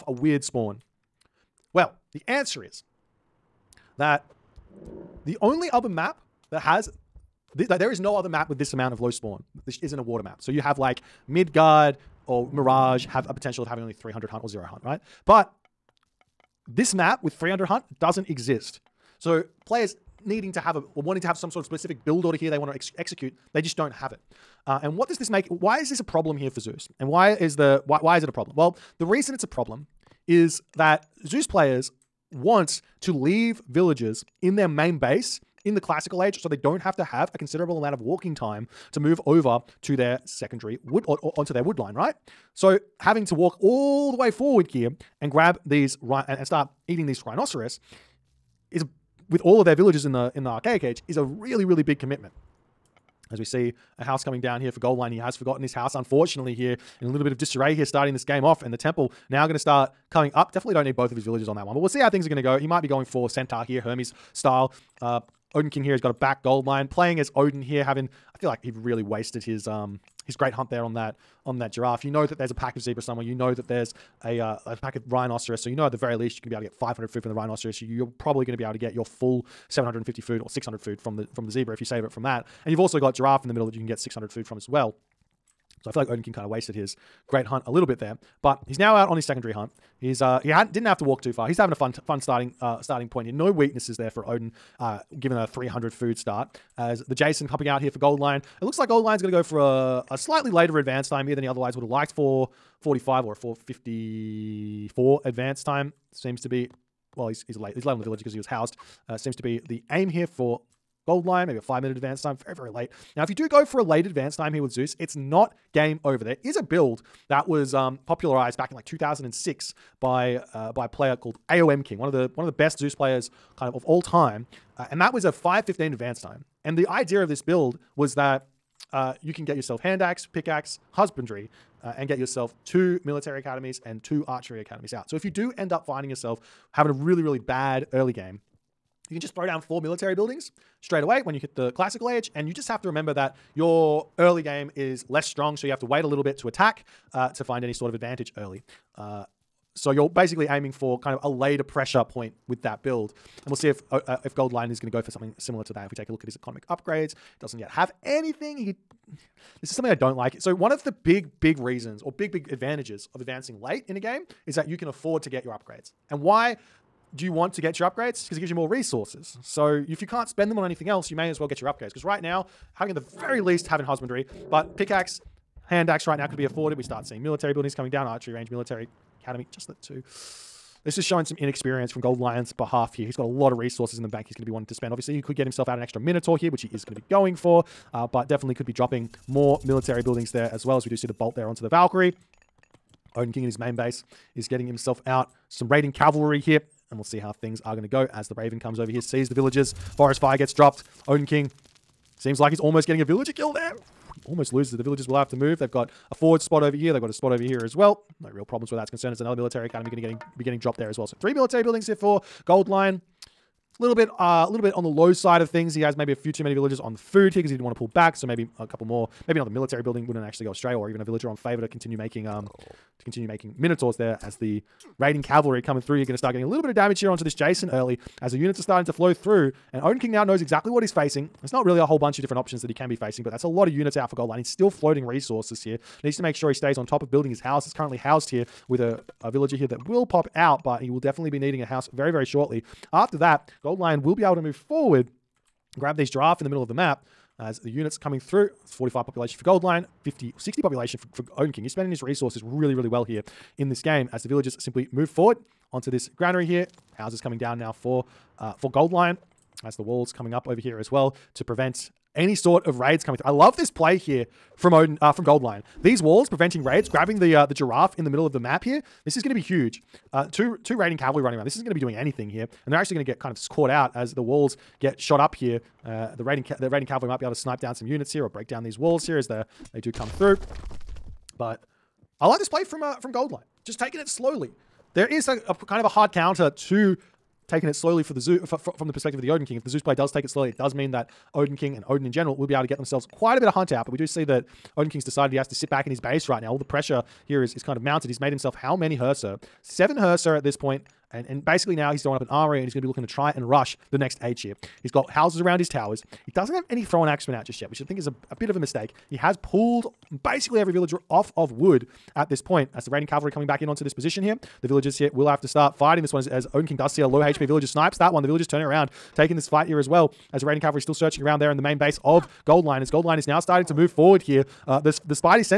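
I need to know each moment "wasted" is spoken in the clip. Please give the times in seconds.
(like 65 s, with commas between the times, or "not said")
69 s, 86 s.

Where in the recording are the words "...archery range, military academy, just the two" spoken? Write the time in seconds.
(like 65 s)
178 s.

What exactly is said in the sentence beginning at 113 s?
Now, if you do go for a late advance time here with Zeus, it's not game over.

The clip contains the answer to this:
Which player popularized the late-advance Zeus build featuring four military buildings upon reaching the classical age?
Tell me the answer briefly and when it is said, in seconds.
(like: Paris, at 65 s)
AOM King, at 121 s.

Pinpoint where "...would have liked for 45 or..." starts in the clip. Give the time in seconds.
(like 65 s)
101 s.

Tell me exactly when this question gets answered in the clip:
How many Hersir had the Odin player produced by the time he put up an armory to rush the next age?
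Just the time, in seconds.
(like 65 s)
299 s.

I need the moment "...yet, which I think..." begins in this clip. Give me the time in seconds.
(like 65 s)
307 s.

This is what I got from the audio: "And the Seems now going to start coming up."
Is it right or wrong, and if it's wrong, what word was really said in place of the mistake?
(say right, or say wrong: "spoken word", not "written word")
wrong: "Temple", not "Seems".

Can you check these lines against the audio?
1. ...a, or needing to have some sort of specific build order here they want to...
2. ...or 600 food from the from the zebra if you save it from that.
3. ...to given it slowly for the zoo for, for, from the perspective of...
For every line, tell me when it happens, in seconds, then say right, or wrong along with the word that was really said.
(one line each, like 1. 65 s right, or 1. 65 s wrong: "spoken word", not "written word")
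1. 20 s wrong: "wanting", not "needing"
2. 80 s right
3. 286 s wrong: "taken", not "given".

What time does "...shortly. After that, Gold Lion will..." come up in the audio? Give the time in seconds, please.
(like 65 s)
242 s.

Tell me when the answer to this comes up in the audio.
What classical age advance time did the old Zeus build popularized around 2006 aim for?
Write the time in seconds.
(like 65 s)
125 s.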